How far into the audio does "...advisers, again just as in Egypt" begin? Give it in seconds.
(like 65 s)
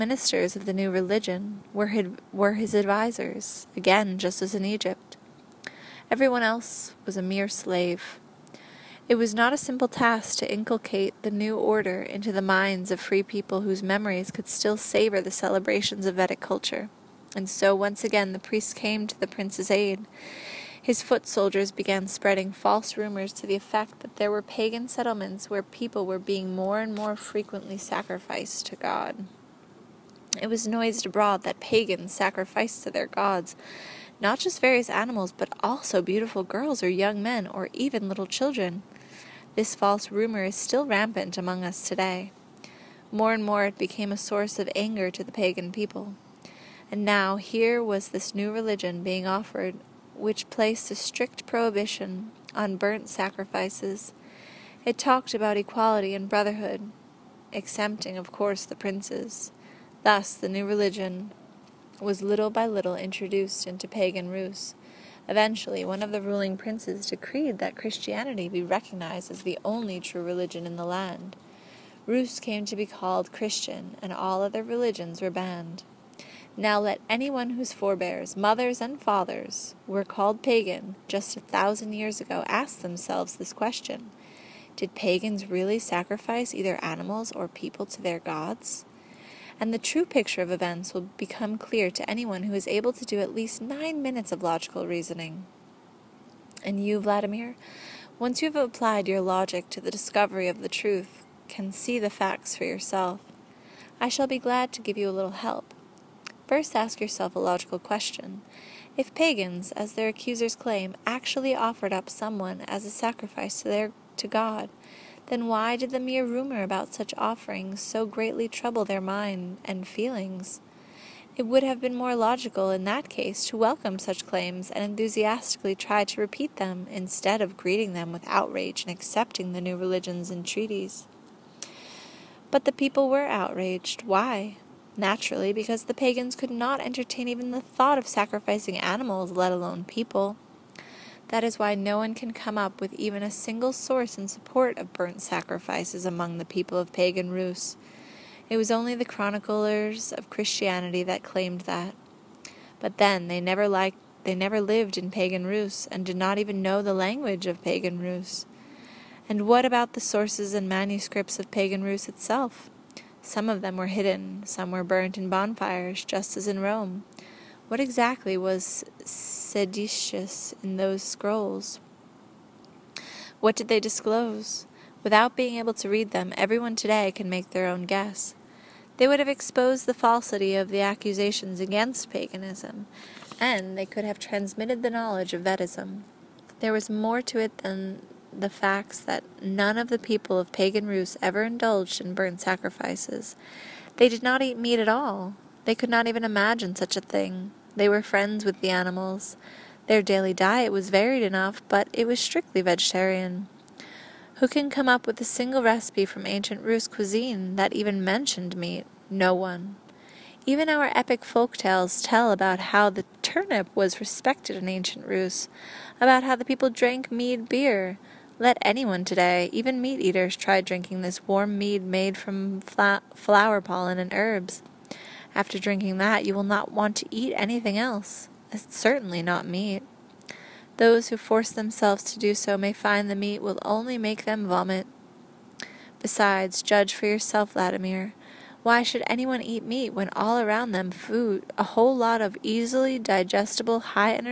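2 s.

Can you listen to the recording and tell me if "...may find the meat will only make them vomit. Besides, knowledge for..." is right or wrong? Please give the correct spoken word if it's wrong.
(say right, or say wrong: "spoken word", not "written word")
wrong: "judge", not "knowledge".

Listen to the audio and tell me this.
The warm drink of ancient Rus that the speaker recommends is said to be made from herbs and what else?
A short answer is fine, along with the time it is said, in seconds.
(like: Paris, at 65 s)
flower pollen, at 222 s.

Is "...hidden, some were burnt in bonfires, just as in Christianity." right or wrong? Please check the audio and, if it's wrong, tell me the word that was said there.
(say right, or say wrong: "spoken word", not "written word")
wrong: "Rome", not "Christianity".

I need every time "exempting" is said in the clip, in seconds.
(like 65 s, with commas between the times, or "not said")
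57 s.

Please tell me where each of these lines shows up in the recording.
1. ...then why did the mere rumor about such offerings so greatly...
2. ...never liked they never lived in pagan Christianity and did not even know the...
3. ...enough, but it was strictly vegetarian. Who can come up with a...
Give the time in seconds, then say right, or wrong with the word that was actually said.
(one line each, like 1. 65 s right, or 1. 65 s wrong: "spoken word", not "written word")
1. 115 s right
2. 153 s wrong: "Rus", not "Christianity"
3. 201 s right.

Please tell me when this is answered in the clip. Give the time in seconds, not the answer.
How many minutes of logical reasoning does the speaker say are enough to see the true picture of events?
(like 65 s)
93 s.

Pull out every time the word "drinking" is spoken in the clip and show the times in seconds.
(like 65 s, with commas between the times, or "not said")
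220 s, 225 s.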